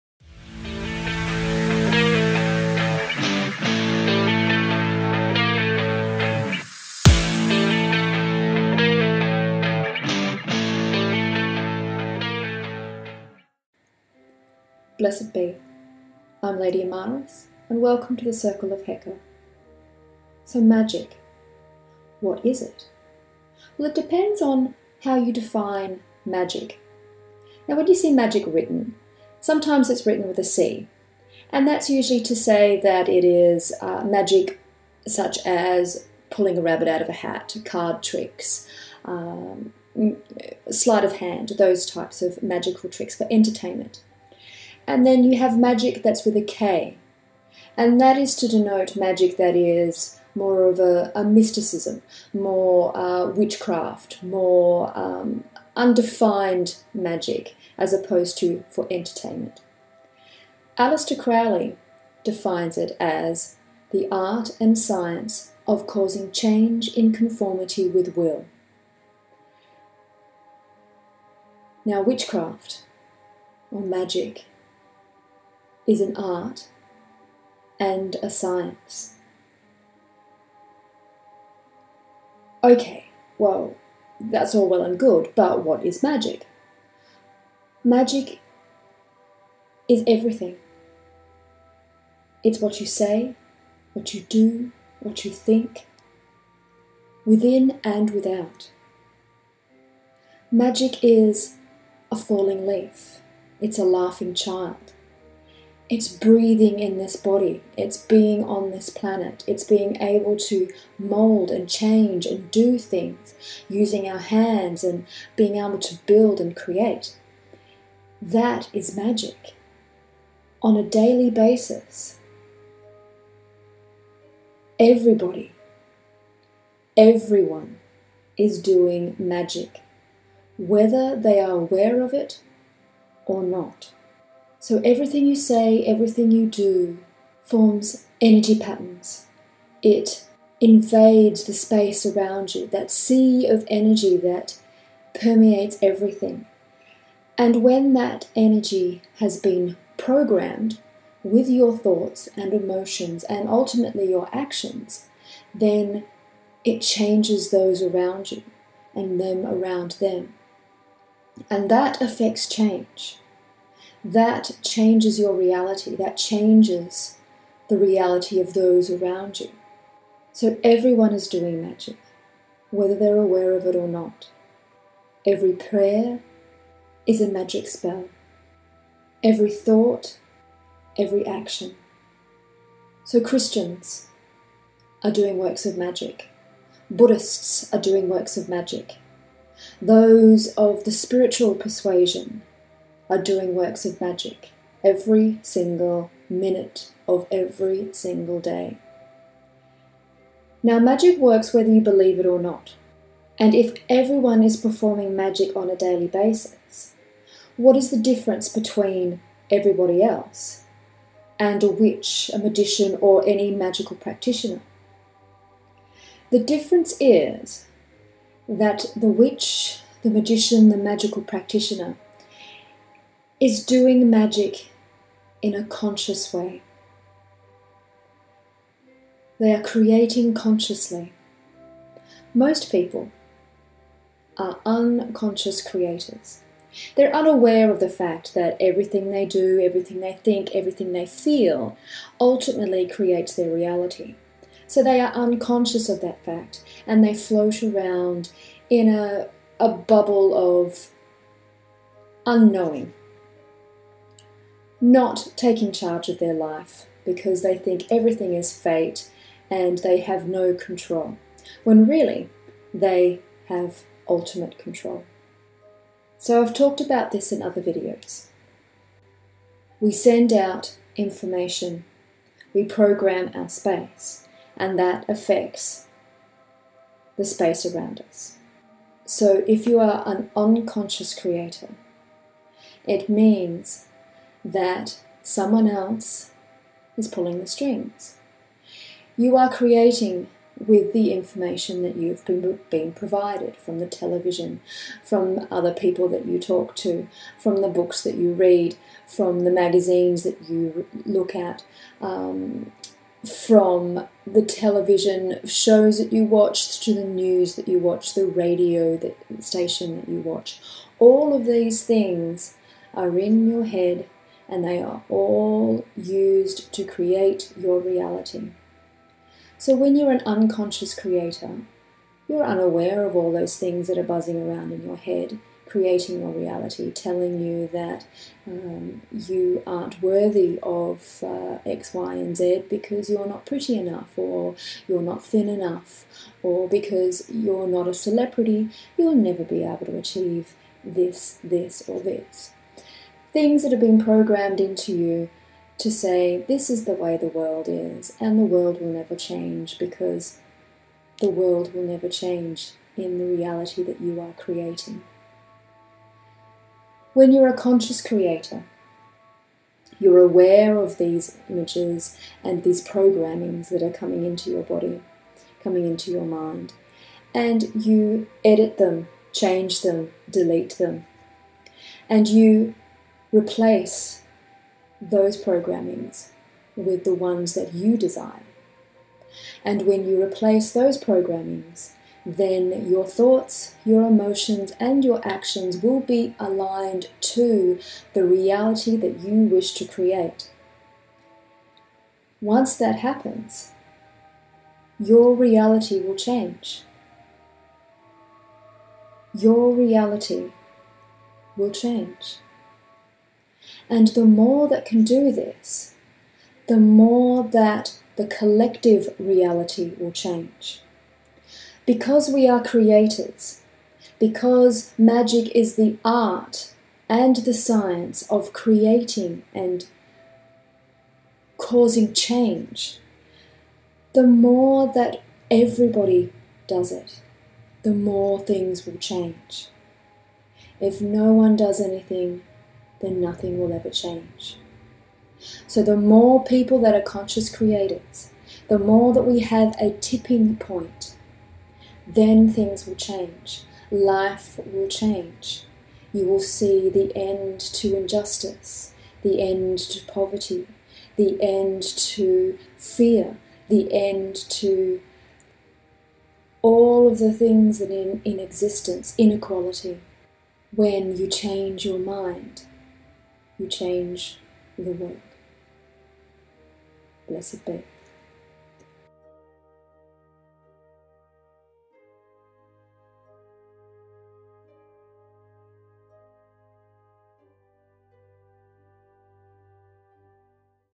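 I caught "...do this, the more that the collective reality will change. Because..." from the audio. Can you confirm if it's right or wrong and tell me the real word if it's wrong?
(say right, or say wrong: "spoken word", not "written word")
right.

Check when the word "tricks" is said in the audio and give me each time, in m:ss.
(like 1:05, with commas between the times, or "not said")
0:38, 0:42.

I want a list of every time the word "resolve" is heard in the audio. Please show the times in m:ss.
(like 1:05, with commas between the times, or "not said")
not said.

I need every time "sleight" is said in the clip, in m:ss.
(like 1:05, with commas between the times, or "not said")
0:40.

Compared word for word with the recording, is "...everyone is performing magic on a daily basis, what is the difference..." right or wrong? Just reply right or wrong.
right.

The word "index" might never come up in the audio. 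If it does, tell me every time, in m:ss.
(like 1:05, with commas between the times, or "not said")
not said.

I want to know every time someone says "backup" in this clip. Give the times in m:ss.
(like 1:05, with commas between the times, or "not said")
not said.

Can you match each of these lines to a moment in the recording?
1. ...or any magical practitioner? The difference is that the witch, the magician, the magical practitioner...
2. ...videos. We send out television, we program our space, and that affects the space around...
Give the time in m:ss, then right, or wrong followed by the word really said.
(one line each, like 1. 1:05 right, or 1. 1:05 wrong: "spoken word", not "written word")
1. 3:33 right
2. 4:27 wrong: "information", not "television".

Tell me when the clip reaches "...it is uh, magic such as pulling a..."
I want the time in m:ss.
0:33.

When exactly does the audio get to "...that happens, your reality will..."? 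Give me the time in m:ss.
6:32.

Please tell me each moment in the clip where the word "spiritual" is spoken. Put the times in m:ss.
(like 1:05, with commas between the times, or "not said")
3:10.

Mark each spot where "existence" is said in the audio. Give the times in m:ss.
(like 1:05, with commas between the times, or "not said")
7:38.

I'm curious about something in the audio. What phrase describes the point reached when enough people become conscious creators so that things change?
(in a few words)
Tipping point.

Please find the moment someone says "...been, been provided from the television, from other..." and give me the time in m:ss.
4:52.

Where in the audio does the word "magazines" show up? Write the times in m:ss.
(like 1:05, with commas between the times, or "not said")
4:59.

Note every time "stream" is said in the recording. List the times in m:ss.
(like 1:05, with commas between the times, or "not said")
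not said.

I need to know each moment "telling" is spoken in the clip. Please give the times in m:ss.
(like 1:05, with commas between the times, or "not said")
5:26.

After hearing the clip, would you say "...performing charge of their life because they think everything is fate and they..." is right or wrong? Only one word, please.
wrong.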